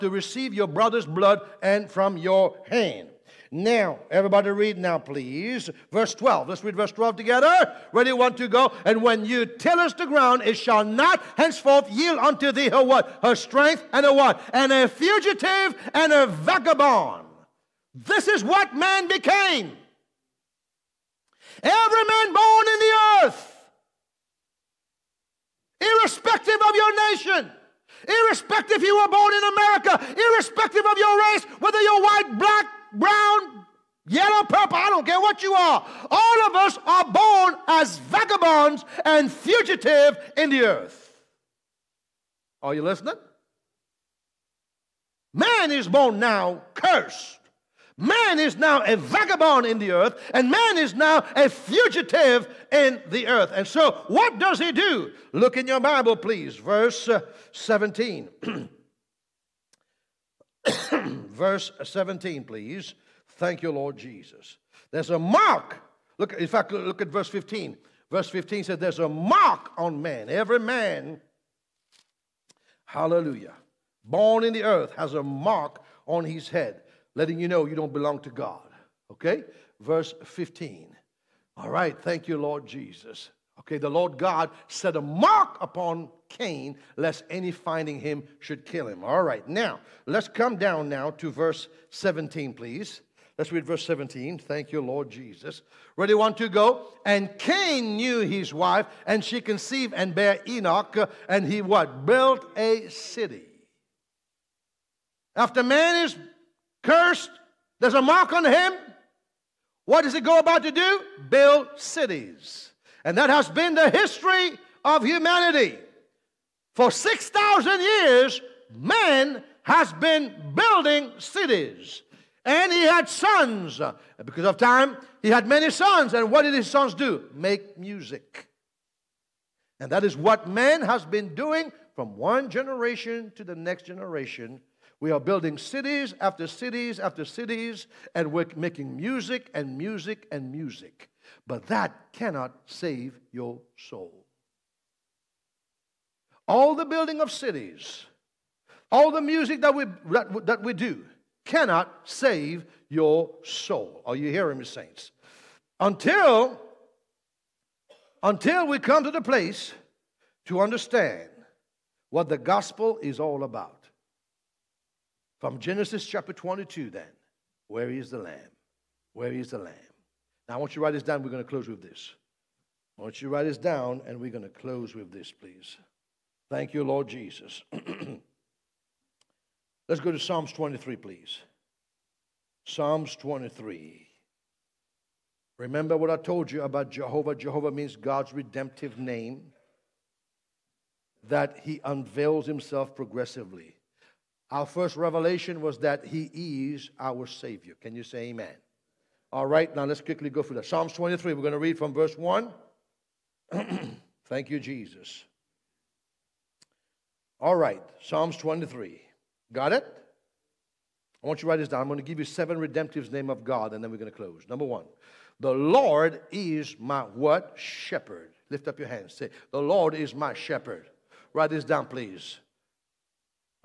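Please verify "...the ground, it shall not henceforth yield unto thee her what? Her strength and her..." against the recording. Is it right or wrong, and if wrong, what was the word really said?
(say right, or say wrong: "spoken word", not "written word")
right.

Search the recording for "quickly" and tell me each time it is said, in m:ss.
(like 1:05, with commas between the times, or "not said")
3:20.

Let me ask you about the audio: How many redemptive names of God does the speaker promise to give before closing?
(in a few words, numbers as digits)
7.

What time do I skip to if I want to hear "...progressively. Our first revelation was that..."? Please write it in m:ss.
3:12.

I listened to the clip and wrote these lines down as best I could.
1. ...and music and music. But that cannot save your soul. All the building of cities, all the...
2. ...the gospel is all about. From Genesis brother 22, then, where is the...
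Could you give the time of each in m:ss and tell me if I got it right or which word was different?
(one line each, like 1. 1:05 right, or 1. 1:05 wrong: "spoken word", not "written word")
1. 2:19 right
2. 2:42 wrong: "chapter", not "brother".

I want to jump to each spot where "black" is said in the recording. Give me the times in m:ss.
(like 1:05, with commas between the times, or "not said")
0:32.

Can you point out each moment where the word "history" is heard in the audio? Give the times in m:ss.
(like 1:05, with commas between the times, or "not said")
1:53.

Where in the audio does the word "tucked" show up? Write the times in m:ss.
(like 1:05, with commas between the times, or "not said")
not said.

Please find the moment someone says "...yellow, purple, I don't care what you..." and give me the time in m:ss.
0:34.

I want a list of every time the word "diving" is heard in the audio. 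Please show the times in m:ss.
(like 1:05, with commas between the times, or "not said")
not said.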